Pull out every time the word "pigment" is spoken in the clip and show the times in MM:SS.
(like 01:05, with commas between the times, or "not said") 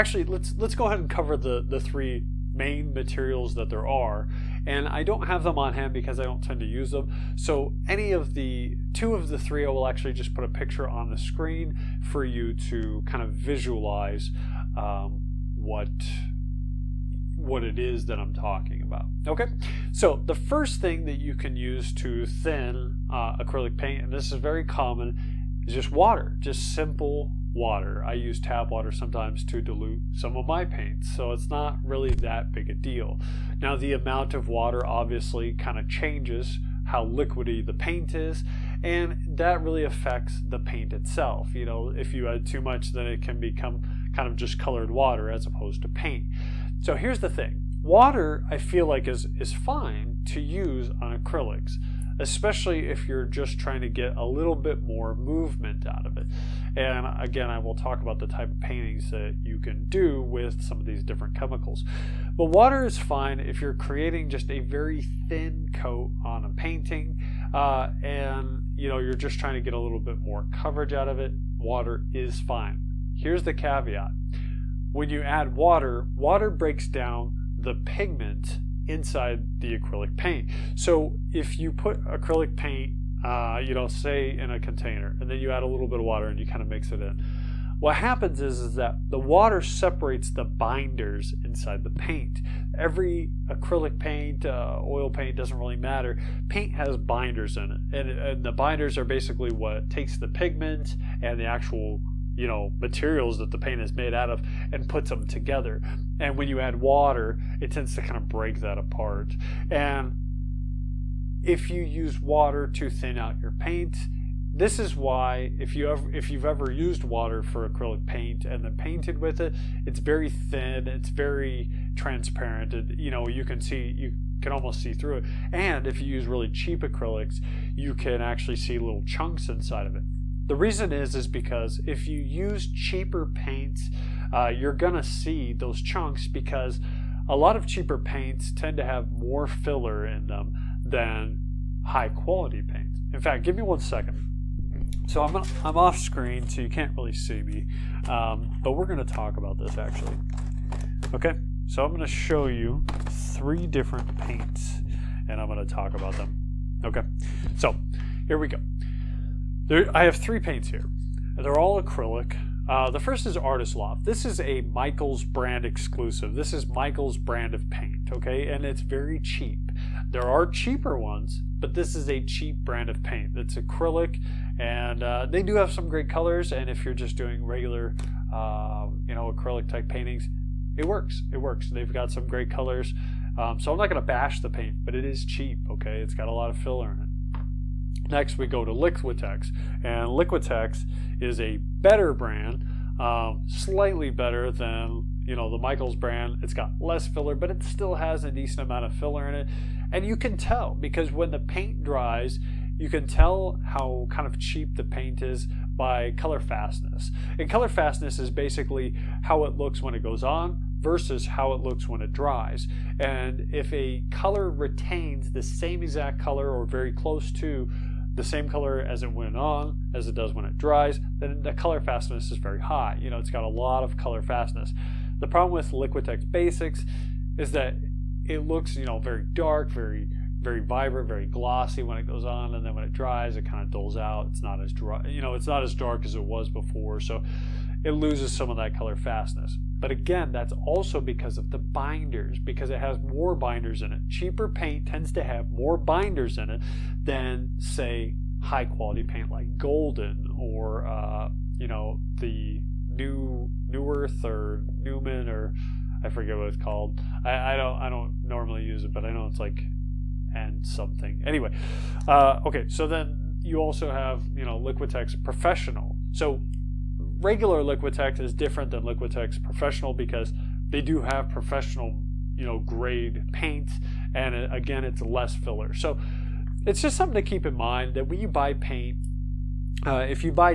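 01:17, 01:40.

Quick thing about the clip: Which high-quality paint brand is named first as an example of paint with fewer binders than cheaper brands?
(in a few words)
Golden.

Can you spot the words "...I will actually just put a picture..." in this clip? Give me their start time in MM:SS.
00:09.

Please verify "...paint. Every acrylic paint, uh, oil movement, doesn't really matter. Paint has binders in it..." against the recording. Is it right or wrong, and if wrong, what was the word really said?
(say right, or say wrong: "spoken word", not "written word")
wrong: "paint", not "movement".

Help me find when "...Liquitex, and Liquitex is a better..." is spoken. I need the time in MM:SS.
03:08.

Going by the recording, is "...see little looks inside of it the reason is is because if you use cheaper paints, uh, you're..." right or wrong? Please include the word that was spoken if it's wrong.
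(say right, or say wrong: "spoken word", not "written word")
wrong: "chunks", not "looks".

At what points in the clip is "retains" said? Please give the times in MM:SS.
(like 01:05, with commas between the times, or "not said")
03:34.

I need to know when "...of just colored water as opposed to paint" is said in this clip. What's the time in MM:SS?
00:44.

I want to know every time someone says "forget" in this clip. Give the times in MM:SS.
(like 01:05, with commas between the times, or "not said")
04:16.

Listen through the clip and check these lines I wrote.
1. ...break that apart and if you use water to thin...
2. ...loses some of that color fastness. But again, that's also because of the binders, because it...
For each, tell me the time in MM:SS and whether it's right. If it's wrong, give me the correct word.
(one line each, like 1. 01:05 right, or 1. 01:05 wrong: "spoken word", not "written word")
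1. 01:48 right
2. 03:57 right.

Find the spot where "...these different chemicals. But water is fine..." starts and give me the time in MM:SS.
01:00.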